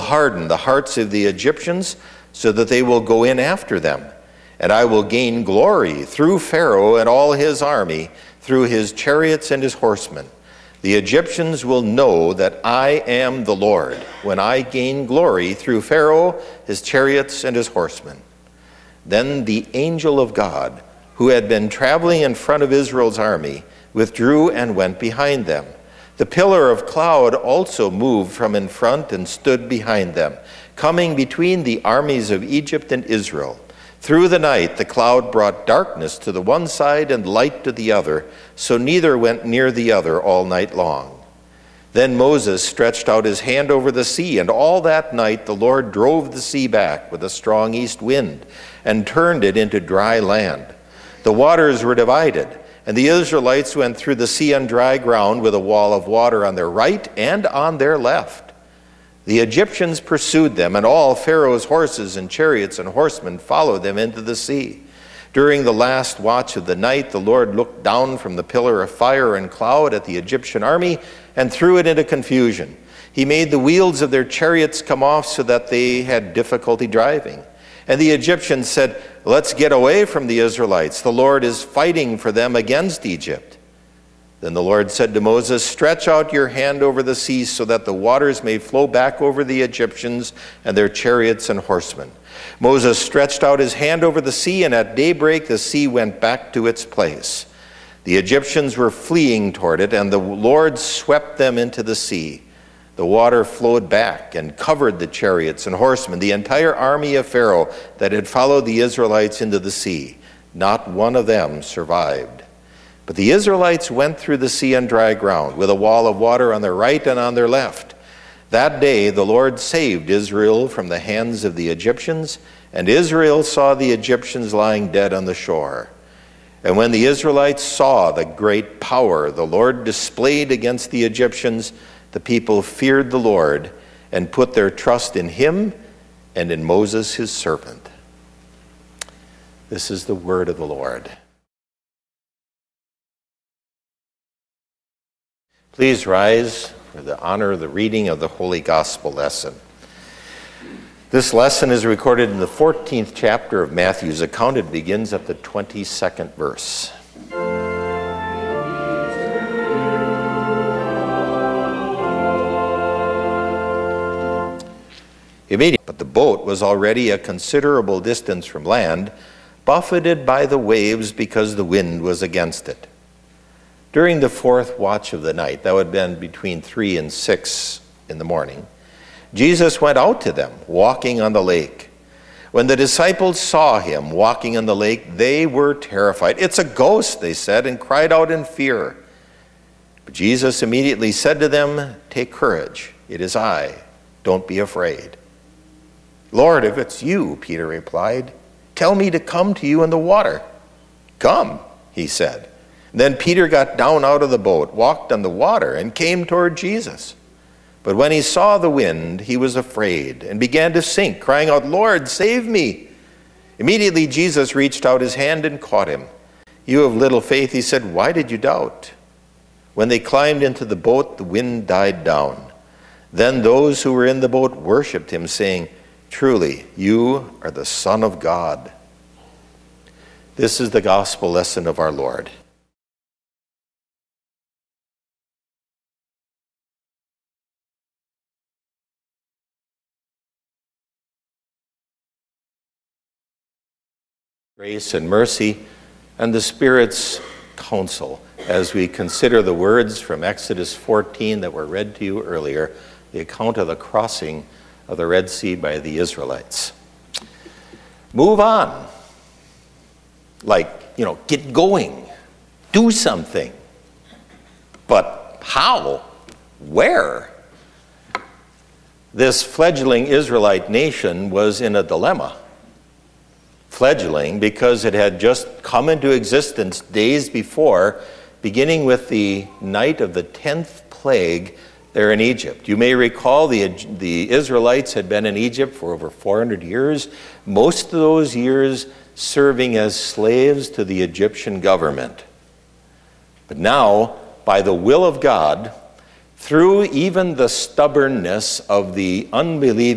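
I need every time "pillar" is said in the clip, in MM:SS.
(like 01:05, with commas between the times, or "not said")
00:26, 01:08.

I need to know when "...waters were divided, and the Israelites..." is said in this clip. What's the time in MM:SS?
00:51.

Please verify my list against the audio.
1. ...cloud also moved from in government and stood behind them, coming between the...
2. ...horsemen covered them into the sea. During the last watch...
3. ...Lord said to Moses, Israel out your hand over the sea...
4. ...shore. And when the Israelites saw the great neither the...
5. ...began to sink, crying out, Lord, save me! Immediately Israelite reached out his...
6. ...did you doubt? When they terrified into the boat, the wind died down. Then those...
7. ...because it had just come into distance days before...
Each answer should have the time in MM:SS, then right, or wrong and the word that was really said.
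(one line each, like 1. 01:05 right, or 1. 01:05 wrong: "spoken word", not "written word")
1. 00:26 wrong: "front", not "government"
2. 01:02 wrong: "followed", not "covered"
3. 01:24 wrong: "Stretch", not "Israel"
4. 02:05 wrong: "power", not "neither"
5. 03:30 wrong: "Jesus", not "Israelite"
6. 03:38 wrong: "climbed", not "terrified"
7. 04:34 wrong: "existence", not "distance".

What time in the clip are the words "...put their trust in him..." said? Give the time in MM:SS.
02:14.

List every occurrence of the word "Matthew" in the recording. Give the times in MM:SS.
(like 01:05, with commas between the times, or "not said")
02:33.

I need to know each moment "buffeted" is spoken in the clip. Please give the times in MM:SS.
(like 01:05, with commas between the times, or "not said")
02:49.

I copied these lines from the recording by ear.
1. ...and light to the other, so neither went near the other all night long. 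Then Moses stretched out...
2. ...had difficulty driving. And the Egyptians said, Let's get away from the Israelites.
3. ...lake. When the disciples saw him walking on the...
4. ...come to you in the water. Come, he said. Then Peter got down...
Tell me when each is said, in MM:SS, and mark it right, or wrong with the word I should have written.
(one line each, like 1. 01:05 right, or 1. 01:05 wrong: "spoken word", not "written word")
1. 00:37 right
2. 01:16 right
3. 03:01 right
4. 03:19 right.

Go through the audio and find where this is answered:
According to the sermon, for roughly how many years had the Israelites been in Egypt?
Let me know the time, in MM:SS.
04:45.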